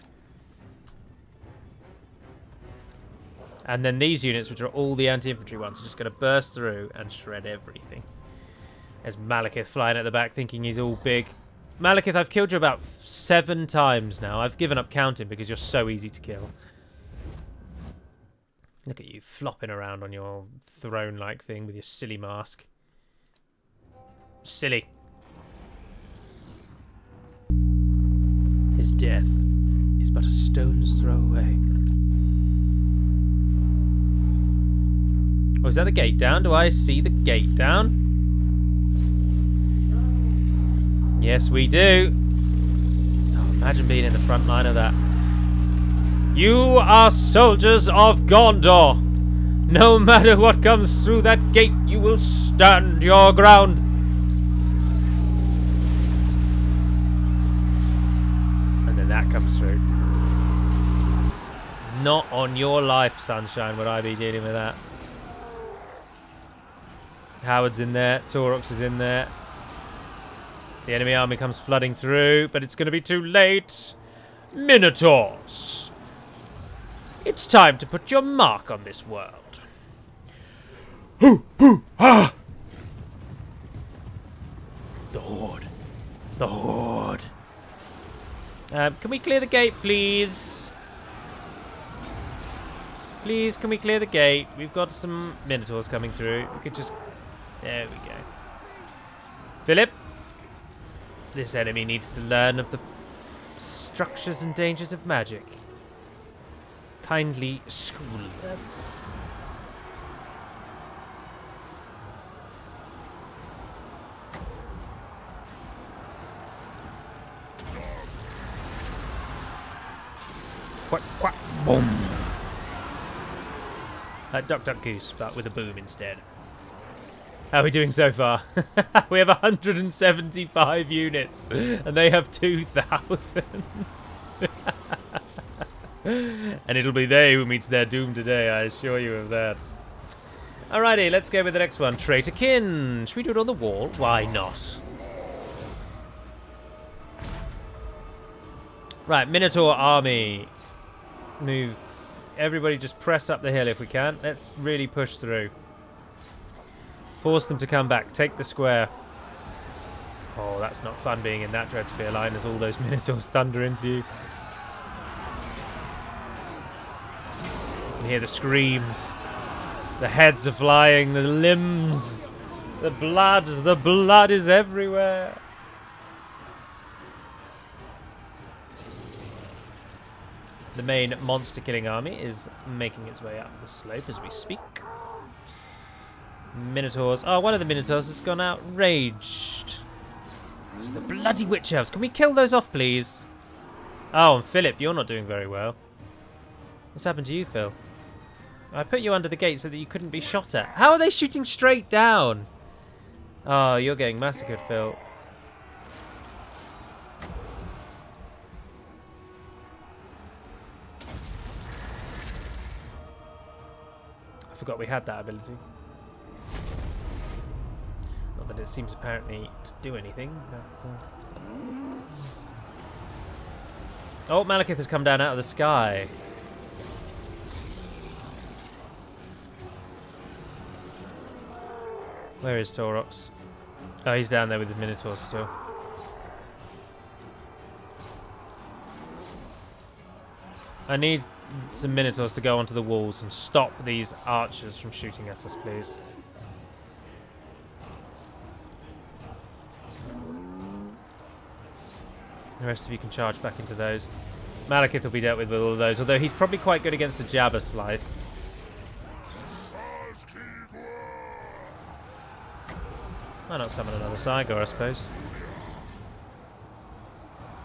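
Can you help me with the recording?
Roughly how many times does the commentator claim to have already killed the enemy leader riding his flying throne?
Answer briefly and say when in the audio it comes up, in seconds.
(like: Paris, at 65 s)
7, at 13 s.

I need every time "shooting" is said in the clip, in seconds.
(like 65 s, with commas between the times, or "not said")
201 s, 244 s.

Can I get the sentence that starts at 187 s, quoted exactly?
Oh, one of the Minotaurs has gone outraged.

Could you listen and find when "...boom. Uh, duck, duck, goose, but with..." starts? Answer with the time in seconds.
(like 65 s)
121 s.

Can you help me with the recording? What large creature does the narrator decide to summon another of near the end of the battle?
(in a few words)
Cygor.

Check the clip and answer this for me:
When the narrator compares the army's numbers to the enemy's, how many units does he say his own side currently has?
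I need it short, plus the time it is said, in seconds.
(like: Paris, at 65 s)
175, at 129 s.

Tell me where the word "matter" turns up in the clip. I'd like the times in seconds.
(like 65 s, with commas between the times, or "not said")
49 s.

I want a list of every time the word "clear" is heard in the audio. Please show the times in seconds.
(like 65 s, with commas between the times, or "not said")
89 s, 93 s.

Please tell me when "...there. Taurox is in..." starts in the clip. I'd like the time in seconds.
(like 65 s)
67 s.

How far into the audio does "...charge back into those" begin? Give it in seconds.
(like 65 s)
253 s.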